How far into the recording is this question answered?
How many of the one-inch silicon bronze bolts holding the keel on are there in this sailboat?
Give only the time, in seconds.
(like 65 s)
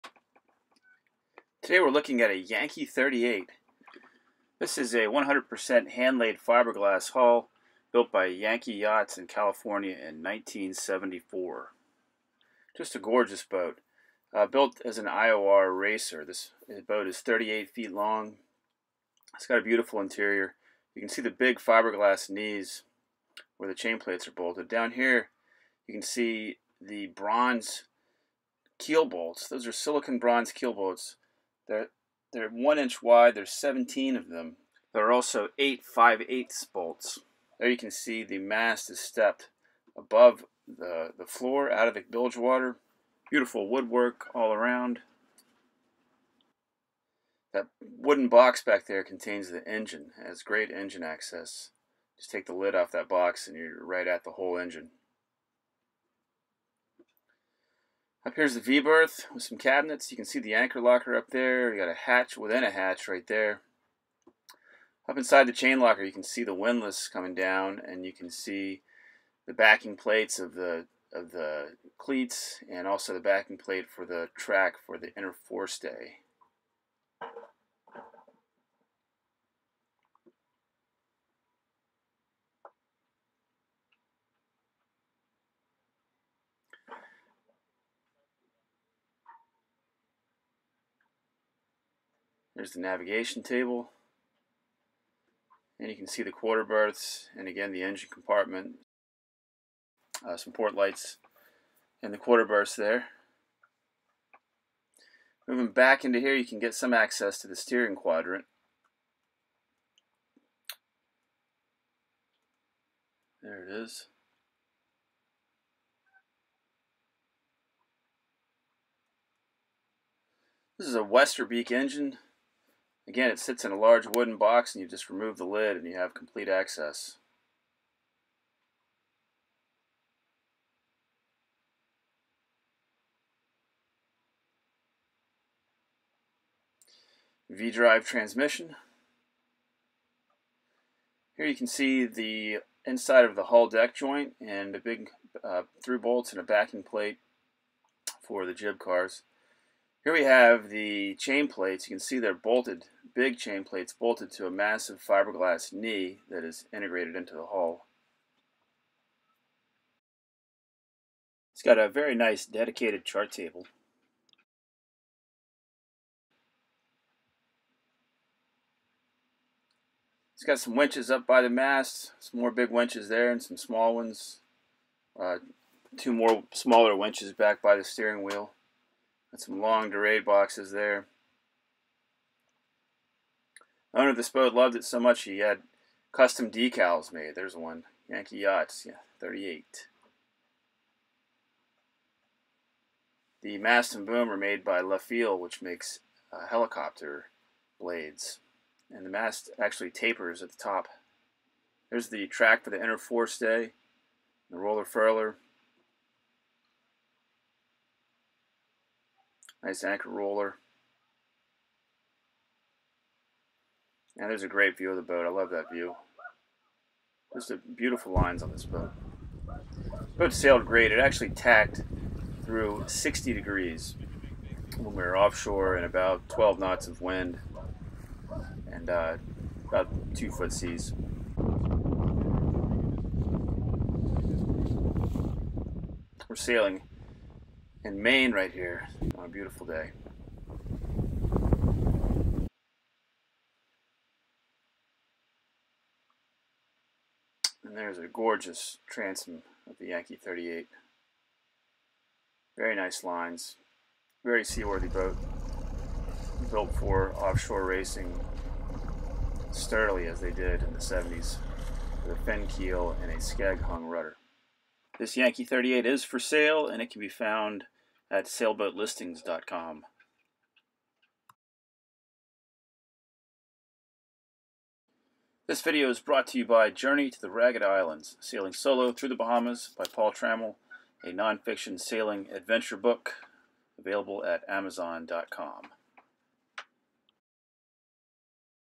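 33 s.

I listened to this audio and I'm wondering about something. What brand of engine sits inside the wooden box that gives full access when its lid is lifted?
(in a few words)
Westerbeke.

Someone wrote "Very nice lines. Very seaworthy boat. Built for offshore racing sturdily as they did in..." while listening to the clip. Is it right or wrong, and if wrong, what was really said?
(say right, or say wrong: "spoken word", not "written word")
right.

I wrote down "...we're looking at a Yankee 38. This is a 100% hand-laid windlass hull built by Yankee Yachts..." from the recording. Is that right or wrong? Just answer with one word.
wrong.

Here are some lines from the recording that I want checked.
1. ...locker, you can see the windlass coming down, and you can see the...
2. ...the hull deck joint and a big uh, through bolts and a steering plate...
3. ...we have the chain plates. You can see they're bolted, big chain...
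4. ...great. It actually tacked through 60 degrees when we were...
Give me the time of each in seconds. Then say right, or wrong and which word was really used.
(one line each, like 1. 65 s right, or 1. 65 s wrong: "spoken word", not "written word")
1. 65 s right
2. 143 s wrong: "backing", not "steering"
3. 150 s right
4. 220 s right.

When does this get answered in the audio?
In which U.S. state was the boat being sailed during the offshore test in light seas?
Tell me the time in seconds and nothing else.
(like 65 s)
238 s.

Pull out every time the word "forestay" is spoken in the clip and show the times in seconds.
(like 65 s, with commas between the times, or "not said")
75 s, 202 s.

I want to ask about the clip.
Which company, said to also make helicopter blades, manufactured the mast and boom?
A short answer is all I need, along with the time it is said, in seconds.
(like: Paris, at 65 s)
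LeFiell, at 194 s.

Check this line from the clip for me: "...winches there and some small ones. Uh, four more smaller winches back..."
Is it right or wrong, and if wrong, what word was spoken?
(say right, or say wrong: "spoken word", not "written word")
wrong: "two", not "four".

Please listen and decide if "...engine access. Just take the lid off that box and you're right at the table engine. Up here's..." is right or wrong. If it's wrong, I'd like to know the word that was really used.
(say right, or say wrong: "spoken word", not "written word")
wrong: "whole", not "table".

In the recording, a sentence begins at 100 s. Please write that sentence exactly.
Uh, some port lights and the quarter berths there.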